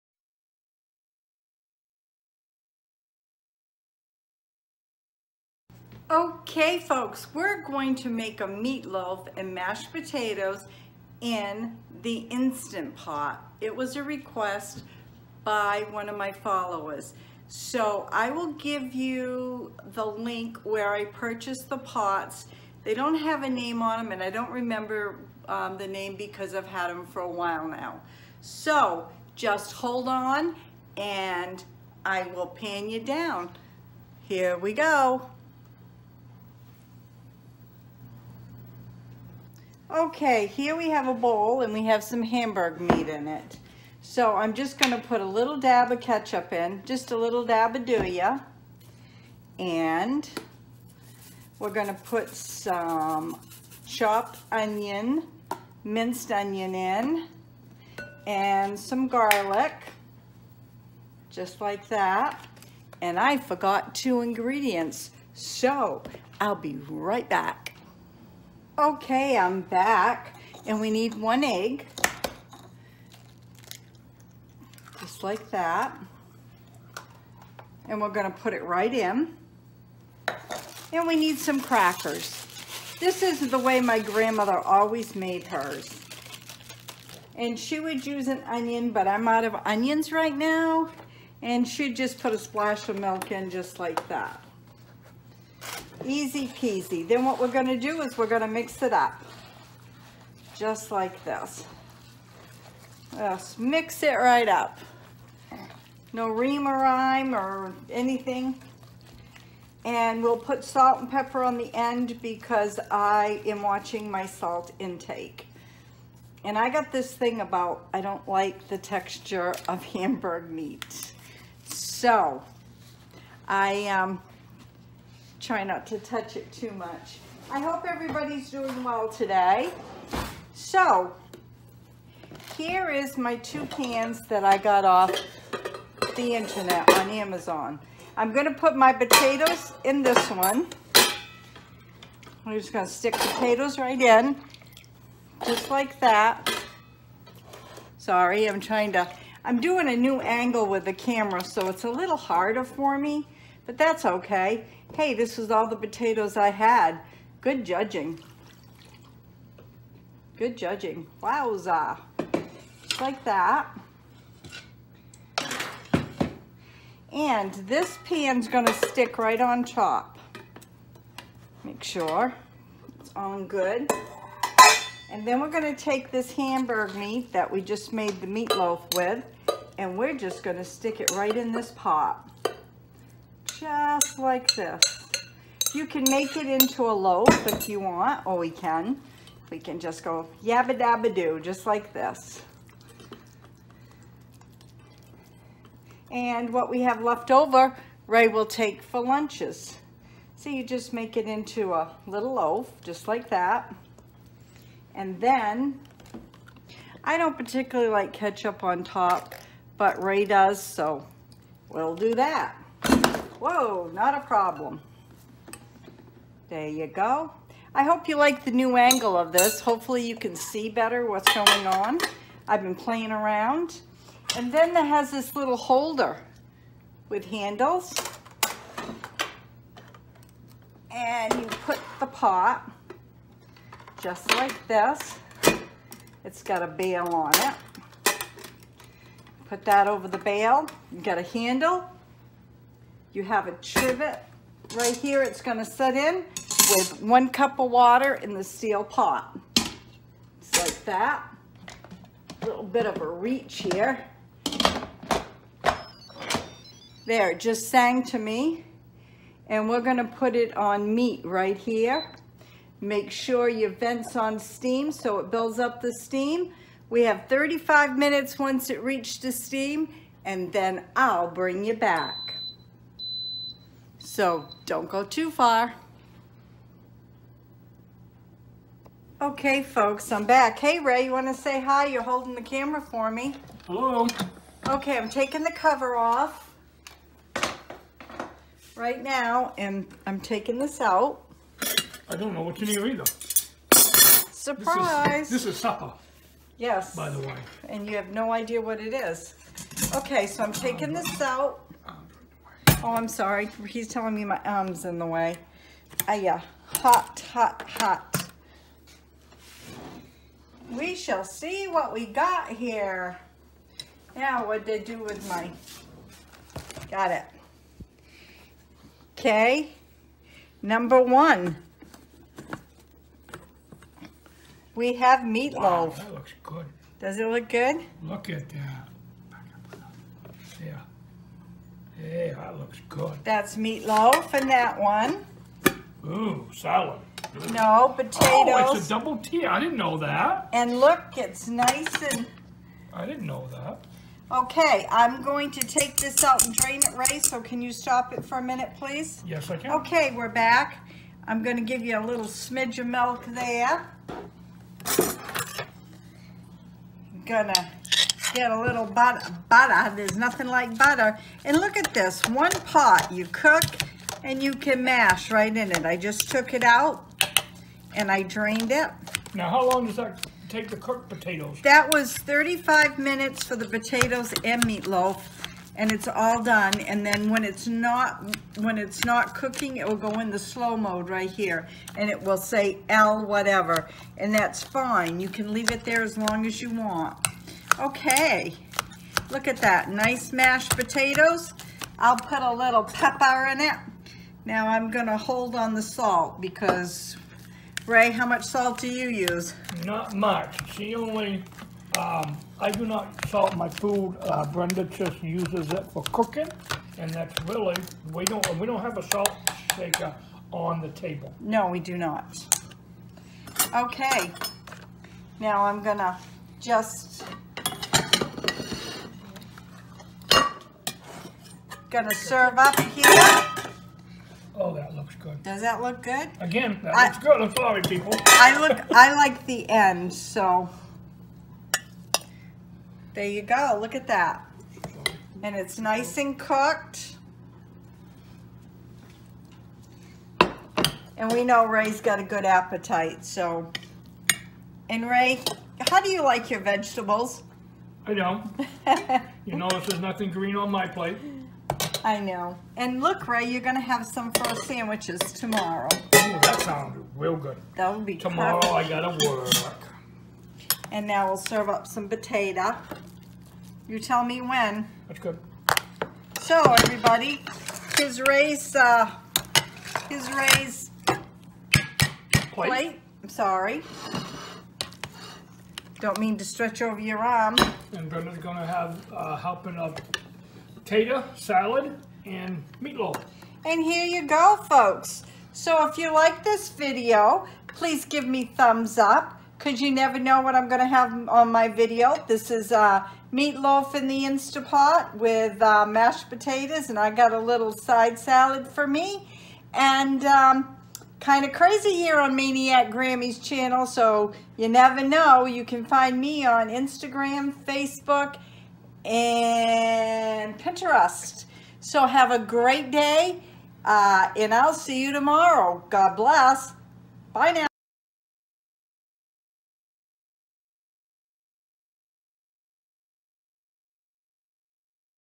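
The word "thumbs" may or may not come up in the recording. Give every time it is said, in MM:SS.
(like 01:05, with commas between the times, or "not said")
08:08.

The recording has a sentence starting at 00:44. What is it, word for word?
So I'm just gonna put a little dab of ketchup in, just a little dab of ya.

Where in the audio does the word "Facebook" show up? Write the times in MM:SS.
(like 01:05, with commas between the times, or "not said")
08:27.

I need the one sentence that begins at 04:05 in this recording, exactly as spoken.
It's gonna set in with one cup of water in the steel pot.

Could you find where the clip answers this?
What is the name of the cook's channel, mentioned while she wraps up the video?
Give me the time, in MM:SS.
08:22.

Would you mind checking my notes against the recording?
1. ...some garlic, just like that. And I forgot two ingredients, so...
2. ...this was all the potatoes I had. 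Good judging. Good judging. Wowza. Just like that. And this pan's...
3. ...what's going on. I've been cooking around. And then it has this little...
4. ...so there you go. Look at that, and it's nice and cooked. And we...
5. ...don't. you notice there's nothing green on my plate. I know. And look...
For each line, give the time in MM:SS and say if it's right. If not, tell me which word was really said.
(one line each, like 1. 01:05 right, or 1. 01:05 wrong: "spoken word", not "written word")
1. 00:58 right
2. 02:35 right
3. 03:41 wrong: "playing", not "cooking"
4. 07:10 right
5. 07:28 right.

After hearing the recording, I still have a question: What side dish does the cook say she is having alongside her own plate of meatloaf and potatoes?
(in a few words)
side salad.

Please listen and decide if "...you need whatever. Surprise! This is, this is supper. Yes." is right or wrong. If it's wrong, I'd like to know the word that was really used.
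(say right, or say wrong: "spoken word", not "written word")
wrong: "either", not "whatever".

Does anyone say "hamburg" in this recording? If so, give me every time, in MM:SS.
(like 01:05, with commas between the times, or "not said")
00:42, 01:59, 02:56.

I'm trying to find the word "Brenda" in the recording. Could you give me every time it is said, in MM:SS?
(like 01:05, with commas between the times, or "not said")
06:44, 07:58.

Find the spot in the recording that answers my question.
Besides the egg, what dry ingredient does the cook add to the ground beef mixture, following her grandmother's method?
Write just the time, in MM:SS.
01:21.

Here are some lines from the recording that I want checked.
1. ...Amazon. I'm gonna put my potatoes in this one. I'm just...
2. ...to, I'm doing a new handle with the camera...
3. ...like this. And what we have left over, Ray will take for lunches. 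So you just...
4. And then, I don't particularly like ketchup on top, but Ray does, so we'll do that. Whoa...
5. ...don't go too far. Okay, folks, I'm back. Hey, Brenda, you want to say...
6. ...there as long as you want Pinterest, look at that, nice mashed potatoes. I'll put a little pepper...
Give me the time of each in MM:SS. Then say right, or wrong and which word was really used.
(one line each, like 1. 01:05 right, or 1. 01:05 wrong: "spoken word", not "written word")
1. 02:17 right
2. 02:28 wrong: "angle", not "handle"
3. 03:11 right
4. 03:24 right
5. 04:34 wrong: "Ray", not "Brenda"
6. 06:25 wrong: "Okay", not "Pinterest".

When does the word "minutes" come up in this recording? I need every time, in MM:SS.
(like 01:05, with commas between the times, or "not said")
04:27, 05:48, 06:12.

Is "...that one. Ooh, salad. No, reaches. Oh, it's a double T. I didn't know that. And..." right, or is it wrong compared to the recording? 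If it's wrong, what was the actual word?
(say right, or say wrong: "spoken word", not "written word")
wrong: "potatoes", not "reaches".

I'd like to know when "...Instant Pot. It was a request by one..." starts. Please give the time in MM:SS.
00:12.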